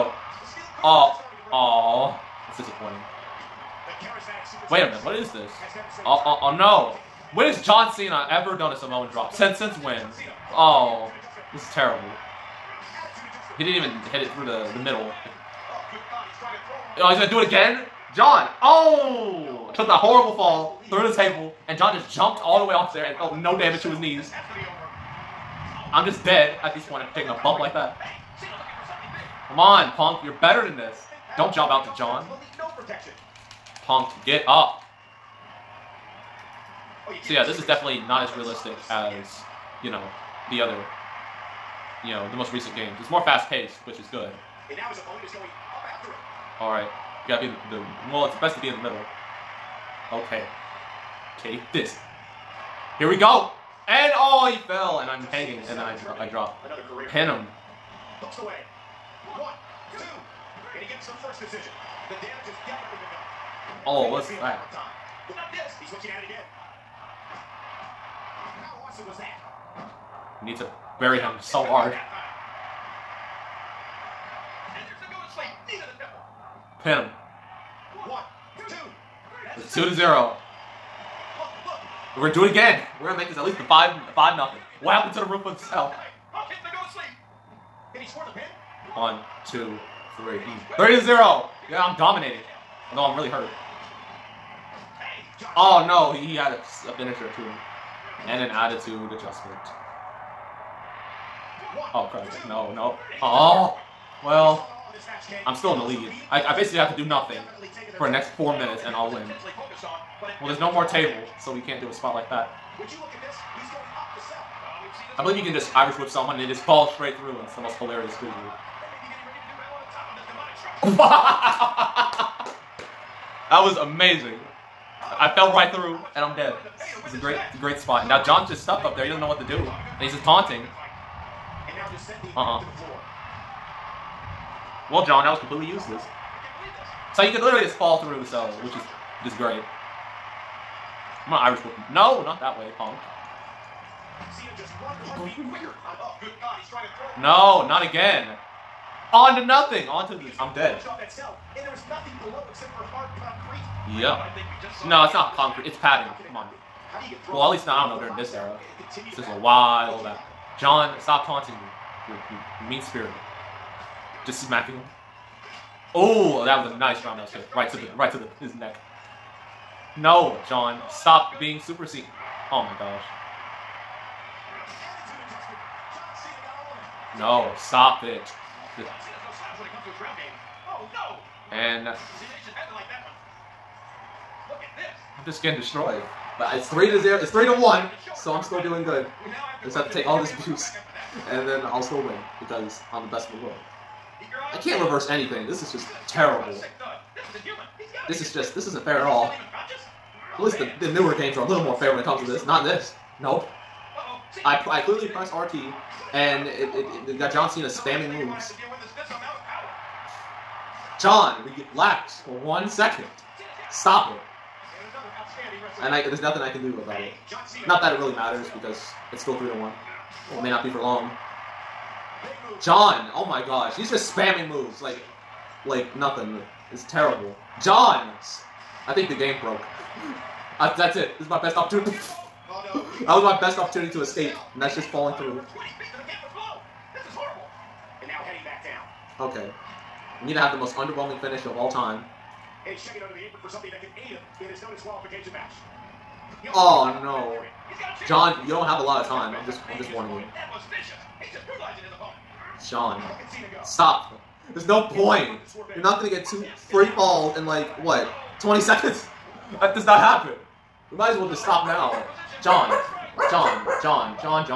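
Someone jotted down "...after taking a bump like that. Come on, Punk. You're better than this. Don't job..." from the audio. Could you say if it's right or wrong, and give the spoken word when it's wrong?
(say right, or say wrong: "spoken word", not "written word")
right.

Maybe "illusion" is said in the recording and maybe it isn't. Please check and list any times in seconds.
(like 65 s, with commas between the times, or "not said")
not said.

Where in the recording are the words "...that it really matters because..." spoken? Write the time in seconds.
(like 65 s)
217 s.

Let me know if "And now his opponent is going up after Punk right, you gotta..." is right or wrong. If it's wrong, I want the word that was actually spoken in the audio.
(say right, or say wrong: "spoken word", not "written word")
wrong: "All", not "Punk".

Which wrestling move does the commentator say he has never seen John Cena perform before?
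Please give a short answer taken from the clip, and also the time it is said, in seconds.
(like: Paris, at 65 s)
Samoan drop, at 8 s.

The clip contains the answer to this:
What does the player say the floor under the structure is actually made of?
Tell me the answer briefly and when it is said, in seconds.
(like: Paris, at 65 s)
Padding, at 155 s.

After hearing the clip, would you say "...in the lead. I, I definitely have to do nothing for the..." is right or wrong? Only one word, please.
wrong.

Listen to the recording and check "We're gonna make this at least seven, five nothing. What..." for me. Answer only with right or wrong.
wrong.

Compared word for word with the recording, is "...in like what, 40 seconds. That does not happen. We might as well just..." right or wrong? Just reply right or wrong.
wrong.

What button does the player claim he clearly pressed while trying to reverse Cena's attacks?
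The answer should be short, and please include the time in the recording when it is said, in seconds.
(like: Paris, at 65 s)
RT, at 205 s.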